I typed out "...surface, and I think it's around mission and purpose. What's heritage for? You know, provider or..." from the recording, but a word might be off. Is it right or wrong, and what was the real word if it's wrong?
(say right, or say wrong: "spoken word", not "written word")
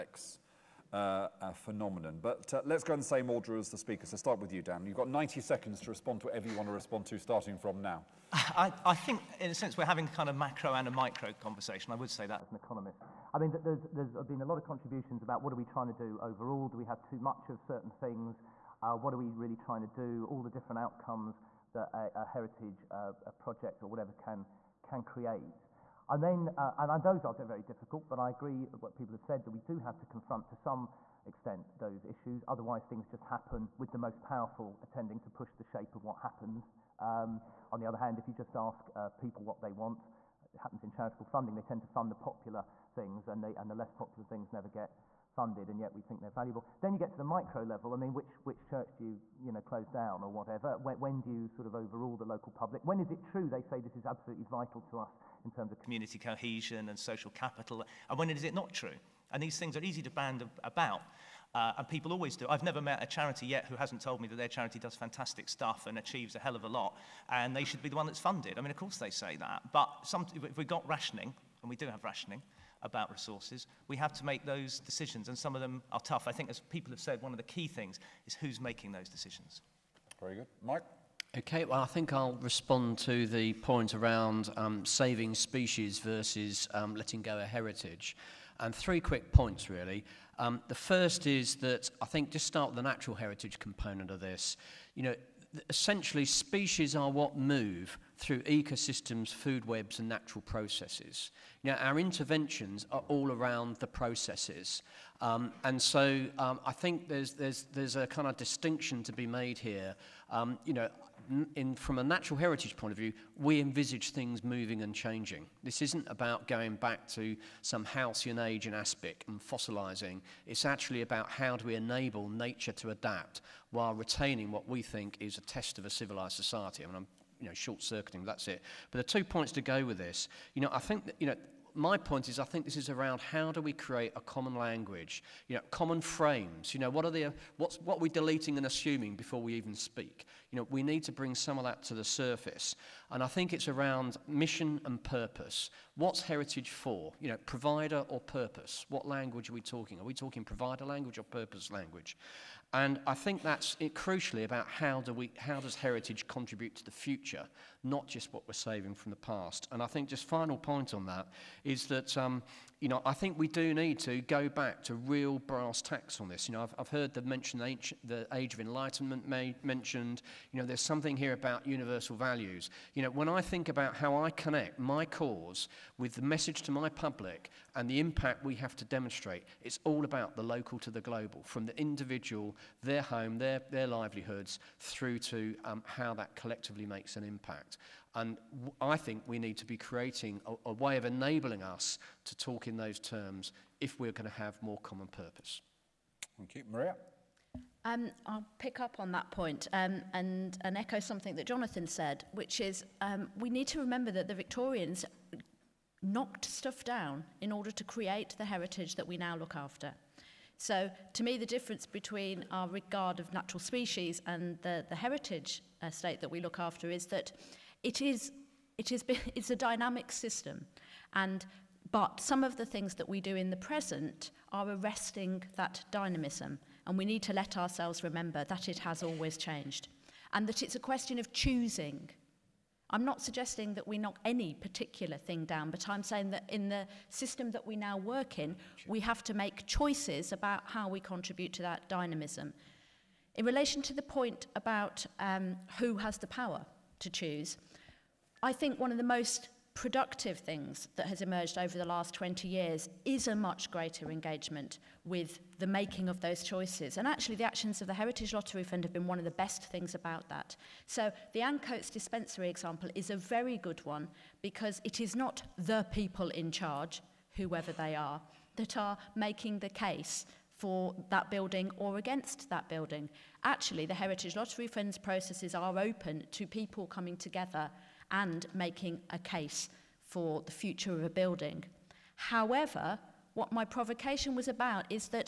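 right.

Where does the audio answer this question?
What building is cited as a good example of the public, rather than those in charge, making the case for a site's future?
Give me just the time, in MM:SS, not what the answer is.
04:21.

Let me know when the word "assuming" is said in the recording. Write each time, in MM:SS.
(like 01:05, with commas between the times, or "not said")
02:18.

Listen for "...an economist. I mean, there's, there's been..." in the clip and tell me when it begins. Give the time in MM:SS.
00:12.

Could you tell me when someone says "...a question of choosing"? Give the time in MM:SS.
03:50.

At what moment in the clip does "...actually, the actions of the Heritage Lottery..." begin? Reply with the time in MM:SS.
04:17.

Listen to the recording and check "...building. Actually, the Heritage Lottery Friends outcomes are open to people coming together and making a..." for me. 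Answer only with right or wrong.
wrong.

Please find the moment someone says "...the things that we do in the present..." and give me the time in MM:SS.
03:42.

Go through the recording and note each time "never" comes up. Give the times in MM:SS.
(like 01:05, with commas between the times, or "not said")
00:44, 01:02.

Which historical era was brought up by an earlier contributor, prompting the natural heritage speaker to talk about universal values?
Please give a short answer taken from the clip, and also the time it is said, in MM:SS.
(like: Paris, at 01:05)
Age of Enlightenment, at 02:48.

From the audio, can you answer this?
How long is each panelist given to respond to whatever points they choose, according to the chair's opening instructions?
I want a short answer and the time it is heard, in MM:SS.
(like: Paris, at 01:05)
90 seconds, at 00:05.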